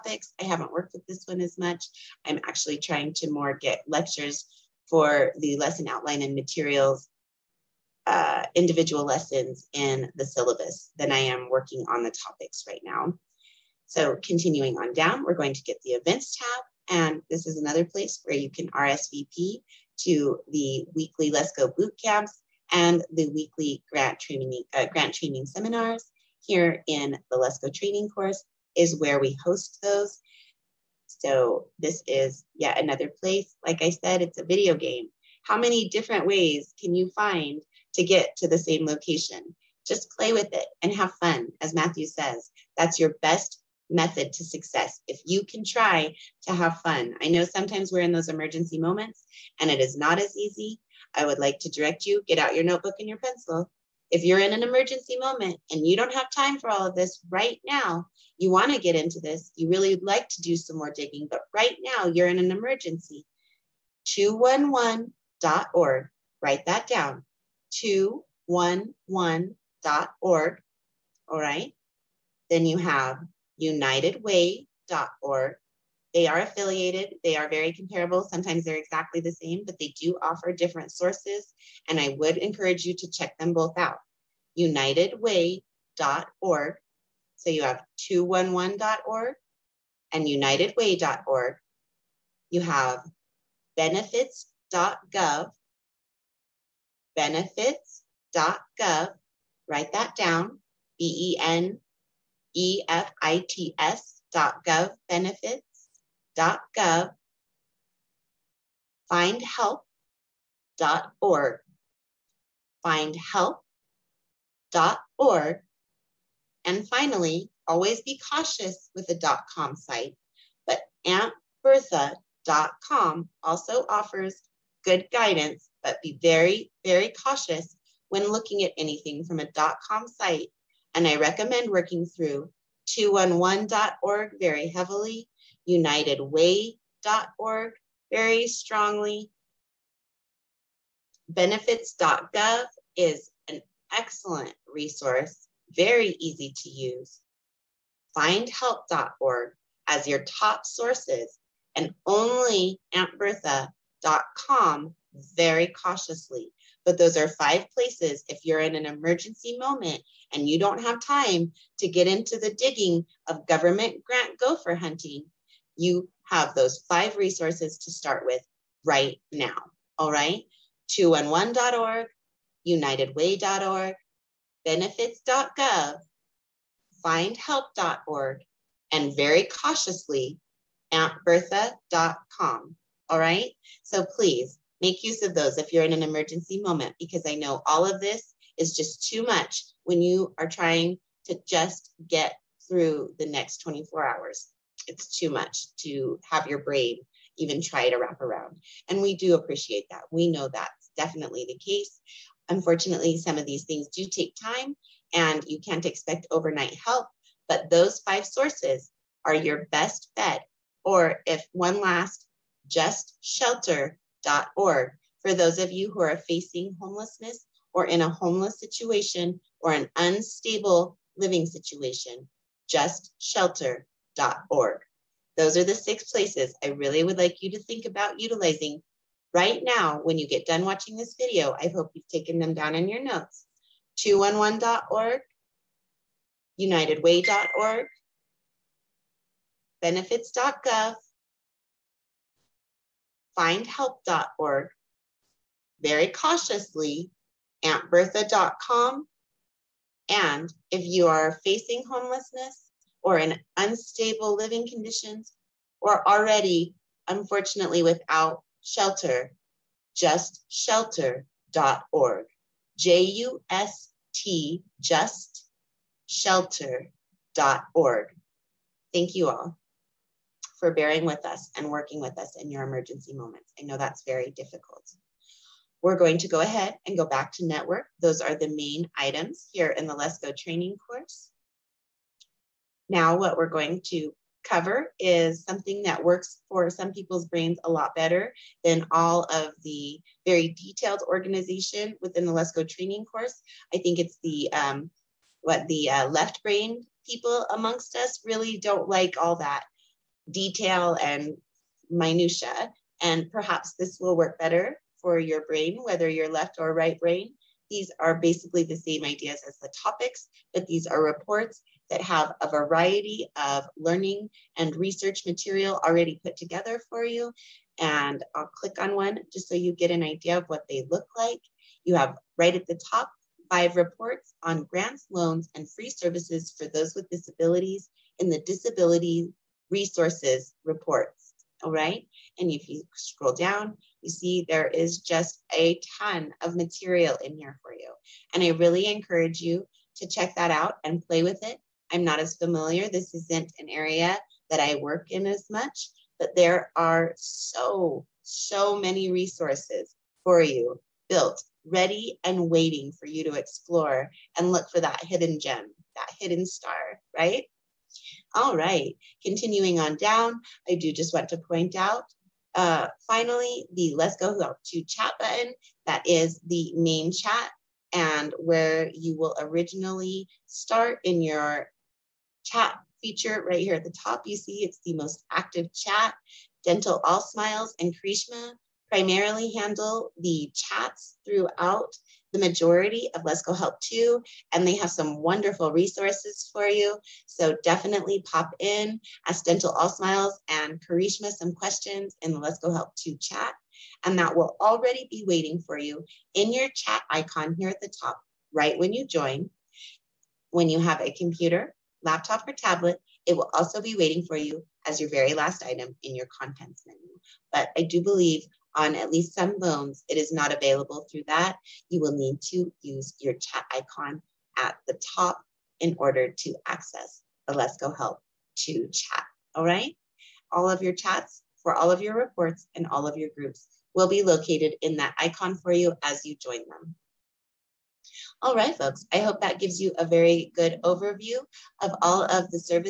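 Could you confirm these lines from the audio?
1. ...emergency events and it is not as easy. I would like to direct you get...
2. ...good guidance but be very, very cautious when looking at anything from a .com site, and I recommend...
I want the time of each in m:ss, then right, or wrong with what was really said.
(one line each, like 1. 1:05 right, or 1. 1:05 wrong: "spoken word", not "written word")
1. 0:48 wrong: "moments", not "events"
2. 2:04 right.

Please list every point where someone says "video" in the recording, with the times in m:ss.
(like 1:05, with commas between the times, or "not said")
0:34, 3:51.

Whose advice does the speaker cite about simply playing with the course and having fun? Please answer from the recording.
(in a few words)
Matthew.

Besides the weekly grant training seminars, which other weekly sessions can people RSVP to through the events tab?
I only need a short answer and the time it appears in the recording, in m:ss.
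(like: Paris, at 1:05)
Lesko boot camps, at 0:21.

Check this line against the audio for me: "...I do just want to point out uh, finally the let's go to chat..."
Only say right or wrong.
right.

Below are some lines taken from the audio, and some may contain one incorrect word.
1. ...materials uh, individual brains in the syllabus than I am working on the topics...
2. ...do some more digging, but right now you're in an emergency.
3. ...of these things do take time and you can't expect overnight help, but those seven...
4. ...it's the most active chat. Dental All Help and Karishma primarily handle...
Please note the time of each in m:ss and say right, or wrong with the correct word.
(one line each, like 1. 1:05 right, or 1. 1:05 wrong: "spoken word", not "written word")
1. 0:06 wrong: "lessons", not "brains"
2. 1:00 right
3. 3:23 wrong: "five", not "seven"
4. 6:14 wrong: "Smiles", not "Help".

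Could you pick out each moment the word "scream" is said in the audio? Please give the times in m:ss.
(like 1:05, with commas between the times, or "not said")
not said.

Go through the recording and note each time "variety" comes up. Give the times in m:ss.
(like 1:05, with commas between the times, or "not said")
5:12.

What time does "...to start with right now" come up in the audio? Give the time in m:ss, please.
2:47.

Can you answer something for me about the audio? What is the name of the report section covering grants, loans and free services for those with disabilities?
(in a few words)
Disability resources.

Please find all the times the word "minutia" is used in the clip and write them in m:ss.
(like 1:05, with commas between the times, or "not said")
5:01.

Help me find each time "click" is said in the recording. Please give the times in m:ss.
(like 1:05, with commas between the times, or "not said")
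5:18.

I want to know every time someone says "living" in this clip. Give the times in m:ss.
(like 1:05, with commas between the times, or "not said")
3:41, 4:14.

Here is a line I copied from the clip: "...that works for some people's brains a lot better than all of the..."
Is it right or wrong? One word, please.
right.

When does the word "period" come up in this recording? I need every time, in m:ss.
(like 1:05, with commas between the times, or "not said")
not said.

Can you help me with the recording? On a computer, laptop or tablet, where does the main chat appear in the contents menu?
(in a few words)
Very last item.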